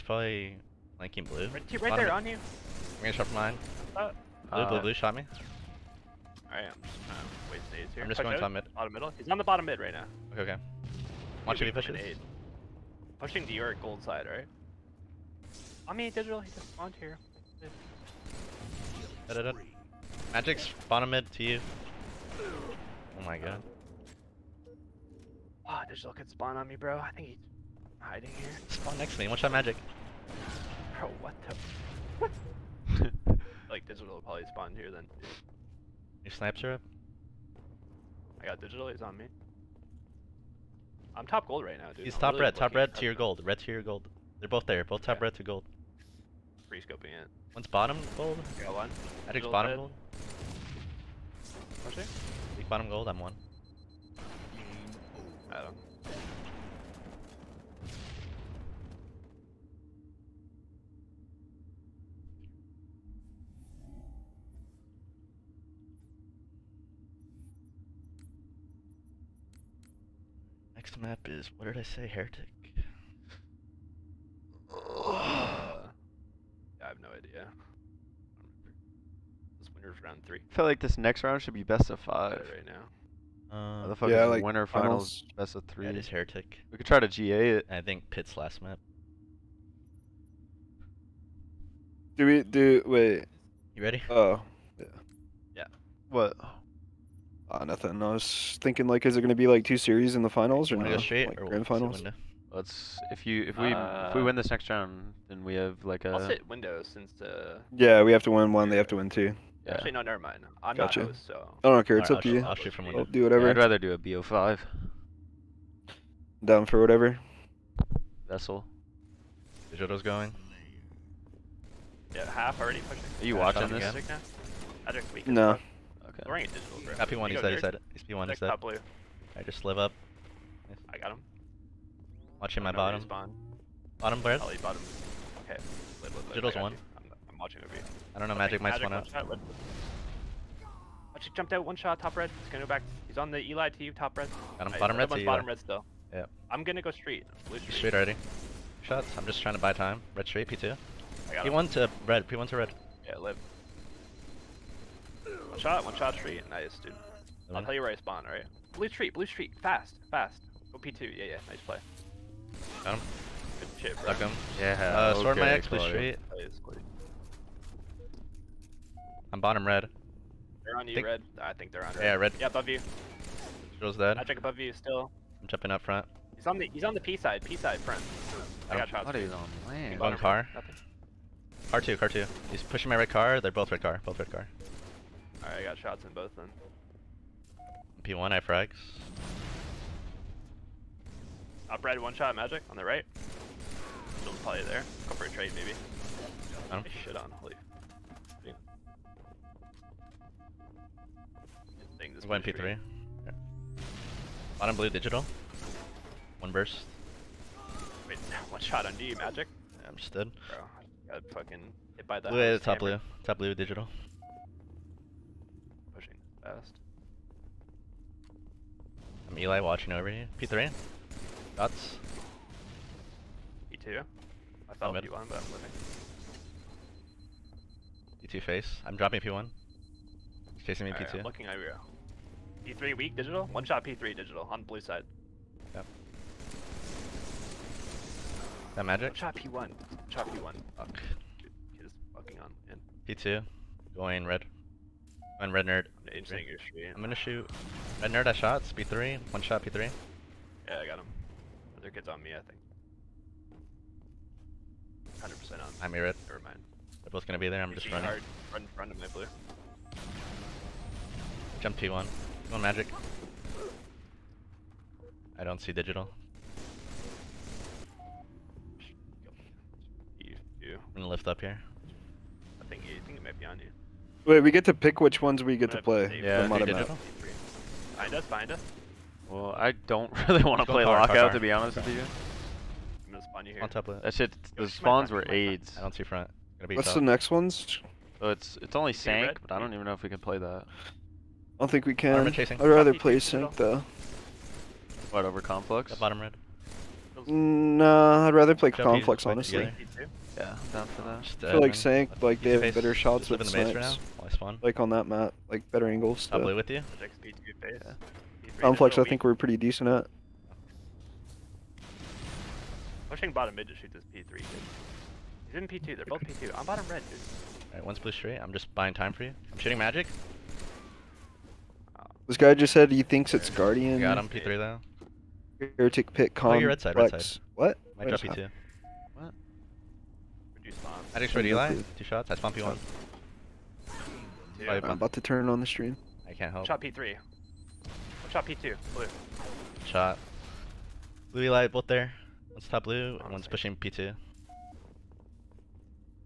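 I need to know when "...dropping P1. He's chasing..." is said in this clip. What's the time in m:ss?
3:48.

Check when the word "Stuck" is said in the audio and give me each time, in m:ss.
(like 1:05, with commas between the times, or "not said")
2:44.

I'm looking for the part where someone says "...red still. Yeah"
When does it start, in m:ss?
2:25.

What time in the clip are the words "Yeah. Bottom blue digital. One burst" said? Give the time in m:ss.
3:23.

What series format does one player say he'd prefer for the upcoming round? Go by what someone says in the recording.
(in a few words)
BO5.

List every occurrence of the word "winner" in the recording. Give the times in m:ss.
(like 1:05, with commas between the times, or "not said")
1:19, 1:24.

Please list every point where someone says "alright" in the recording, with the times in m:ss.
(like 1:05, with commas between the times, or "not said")
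0:06, 2:38, 3:05, 5:17.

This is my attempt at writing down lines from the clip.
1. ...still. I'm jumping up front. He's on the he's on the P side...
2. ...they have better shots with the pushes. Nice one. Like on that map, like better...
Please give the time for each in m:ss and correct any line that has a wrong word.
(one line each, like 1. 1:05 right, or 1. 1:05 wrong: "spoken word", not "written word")
1. 2:54 right
2. 5:02 wrong: "snipes", not "pushes".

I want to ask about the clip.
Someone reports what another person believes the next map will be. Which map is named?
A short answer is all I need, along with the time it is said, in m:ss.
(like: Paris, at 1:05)
Guardian, at 5:23.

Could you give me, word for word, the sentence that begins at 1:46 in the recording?
I'll us hit Windows since the.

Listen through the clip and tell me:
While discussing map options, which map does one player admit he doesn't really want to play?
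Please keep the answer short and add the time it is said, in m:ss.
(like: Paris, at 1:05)
Lockout, at 4:40.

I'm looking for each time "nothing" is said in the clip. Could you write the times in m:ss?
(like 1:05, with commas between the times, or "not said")
1:37, 3:00.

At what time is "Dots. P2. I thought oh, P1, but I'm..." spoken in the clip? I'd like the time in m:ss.
3:41.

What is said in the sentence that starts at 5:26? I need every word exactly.
Oh, you're red side, red side.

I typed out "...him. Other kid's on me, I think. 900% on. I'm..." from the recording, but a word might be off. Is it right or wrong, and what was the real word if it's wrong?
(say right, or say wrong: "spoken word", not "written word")
wrong: "100", not "900".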